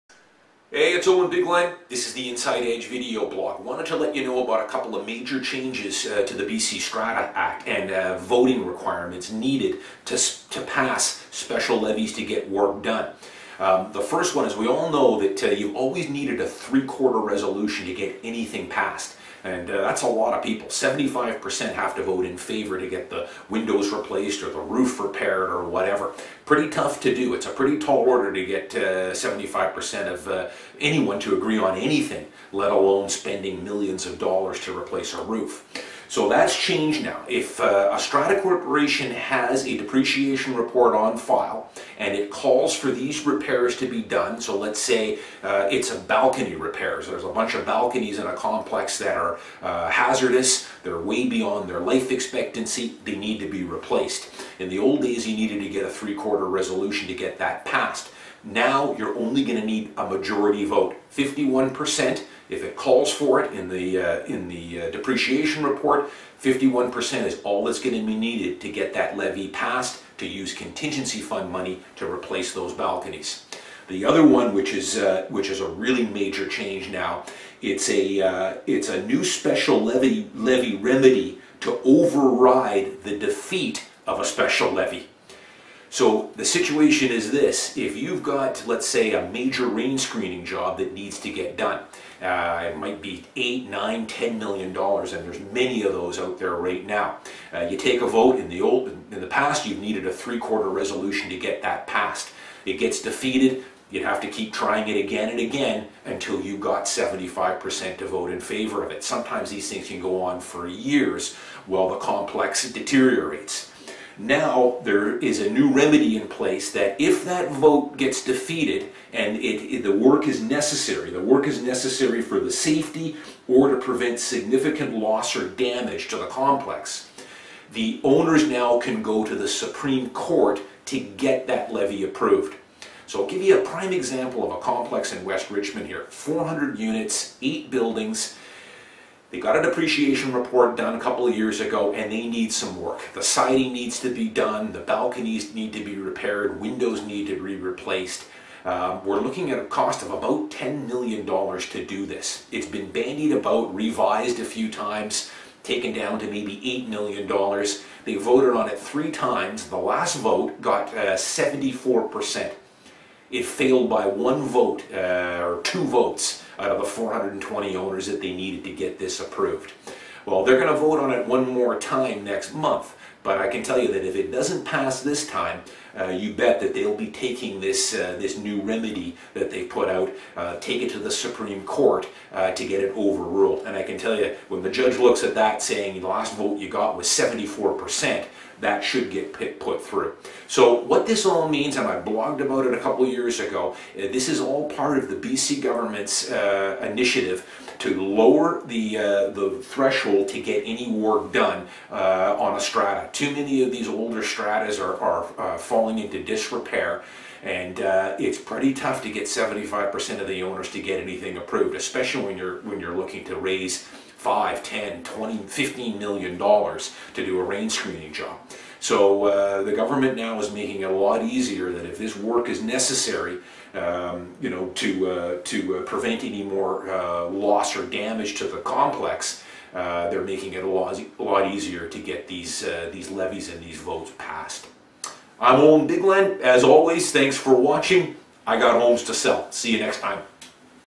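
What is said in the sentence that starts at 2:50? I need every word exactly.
Well, they're going to vote on it one more time next month.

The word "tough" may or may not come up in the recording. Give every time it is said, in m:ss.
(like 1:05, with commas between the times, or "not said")
0:26, 3:28.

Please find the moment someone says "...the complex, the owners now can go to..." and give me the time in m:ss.
2:06.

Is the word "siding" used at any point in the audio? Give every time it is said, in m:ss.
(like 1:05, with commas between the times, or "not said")
2:23.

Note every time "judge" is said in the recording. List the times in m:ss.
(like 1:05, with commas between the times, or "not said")
3:04.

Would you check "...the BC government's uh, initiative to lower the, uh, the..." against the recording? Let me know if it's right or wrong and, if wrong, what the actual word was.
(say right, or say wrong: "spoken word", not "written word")
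right.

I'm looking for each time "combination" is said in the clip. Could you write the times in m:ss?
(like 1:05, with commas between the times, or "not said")
not said.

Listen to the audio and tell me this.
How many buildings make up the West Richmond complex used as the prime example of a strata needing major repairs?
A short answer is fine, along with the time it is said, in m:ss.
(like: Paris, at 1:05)
8, at 2:17.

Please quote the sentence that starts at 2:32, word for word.
It's been bandied about, revised a few times, taken down to maybe $8 million.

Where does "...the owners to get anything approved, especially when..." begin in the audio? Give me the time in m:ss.
3:30.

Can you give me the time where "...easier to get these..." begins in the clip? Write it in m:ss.
3:51.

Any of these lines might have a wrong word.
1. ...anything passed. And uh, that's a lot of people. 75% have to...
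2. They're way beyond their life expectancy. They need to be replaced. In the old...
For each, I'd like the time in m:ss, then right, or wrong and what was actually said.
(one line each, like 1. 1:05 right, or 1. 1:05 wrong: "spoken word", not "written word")
1. 0:18 right
2. 0:50 right.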